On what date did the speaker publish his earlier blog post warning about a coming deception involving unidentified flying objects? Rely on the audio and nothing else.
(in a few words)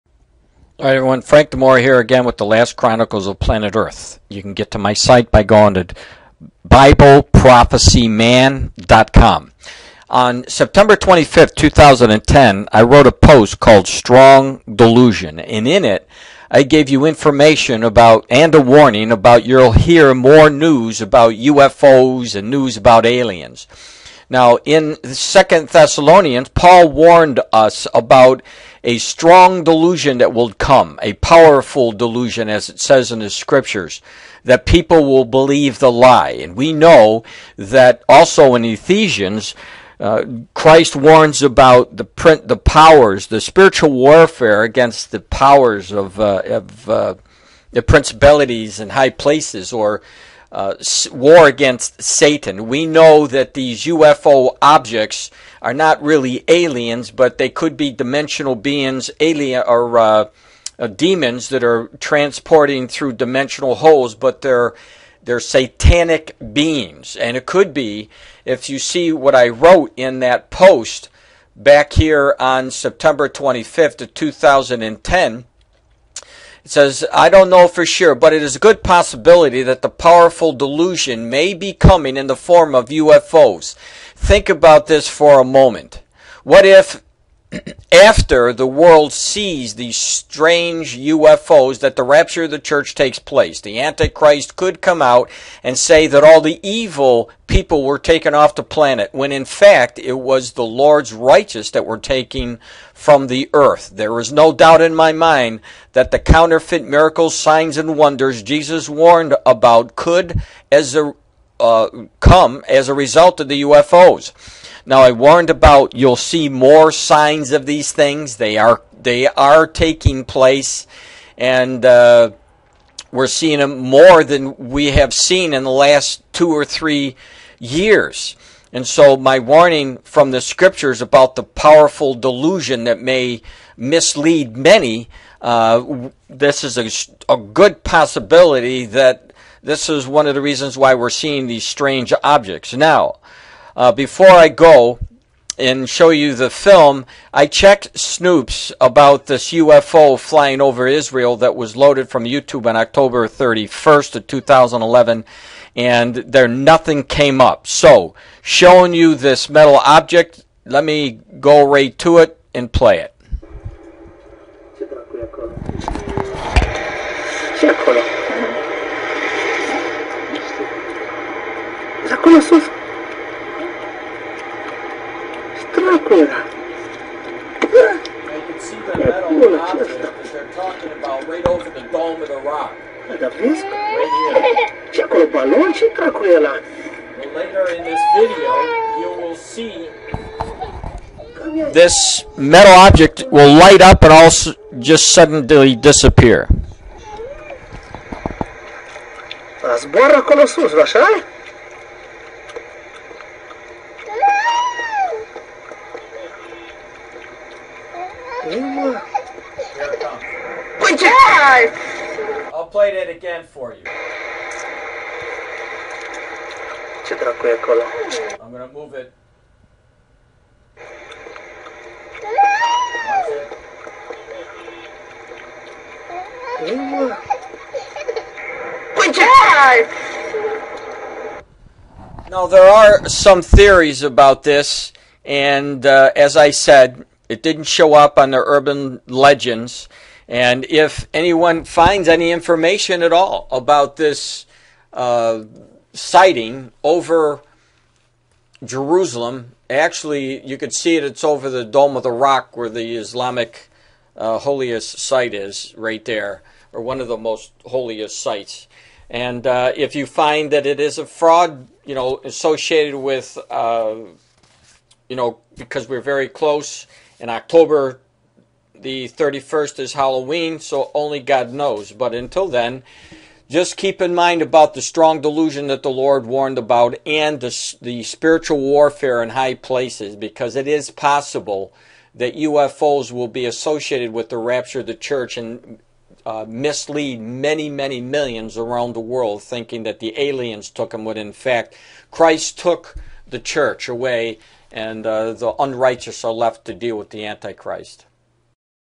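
September 25, 2010.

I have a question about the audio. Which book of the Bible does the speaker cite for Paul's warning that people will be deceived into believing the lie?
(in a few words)
Second Thessalonians.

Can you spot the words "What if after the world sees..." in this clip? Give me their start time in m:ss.
1:26.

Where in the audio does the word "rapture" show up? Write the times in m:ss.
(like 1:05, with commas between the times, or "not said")
1:32, 4:44.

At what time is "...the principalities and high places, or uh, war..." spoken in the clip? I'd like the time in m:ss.
0:47.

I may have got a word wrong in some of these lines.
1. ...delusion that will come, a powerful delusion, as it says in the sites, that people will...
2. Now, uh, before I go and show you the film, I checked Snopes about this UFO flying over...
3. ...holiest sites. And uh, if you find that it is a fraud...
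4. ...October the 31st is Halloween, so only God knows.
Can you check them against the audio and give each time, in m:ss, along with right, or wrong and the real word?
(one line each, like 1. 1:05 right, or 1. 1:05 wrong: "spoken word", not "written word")
1. 0:29 wrong: "scriptures", not "sites"
2. 2:22 right
3. 4:17 right
4. 4:27 right.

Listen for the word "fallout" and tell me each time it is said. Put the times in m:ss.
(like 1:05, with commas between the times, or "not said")
not said.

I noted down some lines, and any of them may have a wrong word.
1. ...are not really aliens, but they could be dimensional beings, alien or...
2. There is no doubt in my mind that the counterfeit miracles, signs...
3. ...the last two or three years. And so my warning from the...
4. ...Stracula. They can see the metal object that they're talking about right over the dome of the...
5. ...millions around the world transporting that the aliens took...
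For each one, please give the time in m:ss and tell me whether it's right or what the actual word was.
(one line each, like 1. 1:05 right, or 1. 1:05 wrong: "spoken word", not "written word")
1. 0:55 right
2. 1:43 right
3. 2:05 right
4. 2:55 right
5. 4:48 wrong: "thinking", not "transporting".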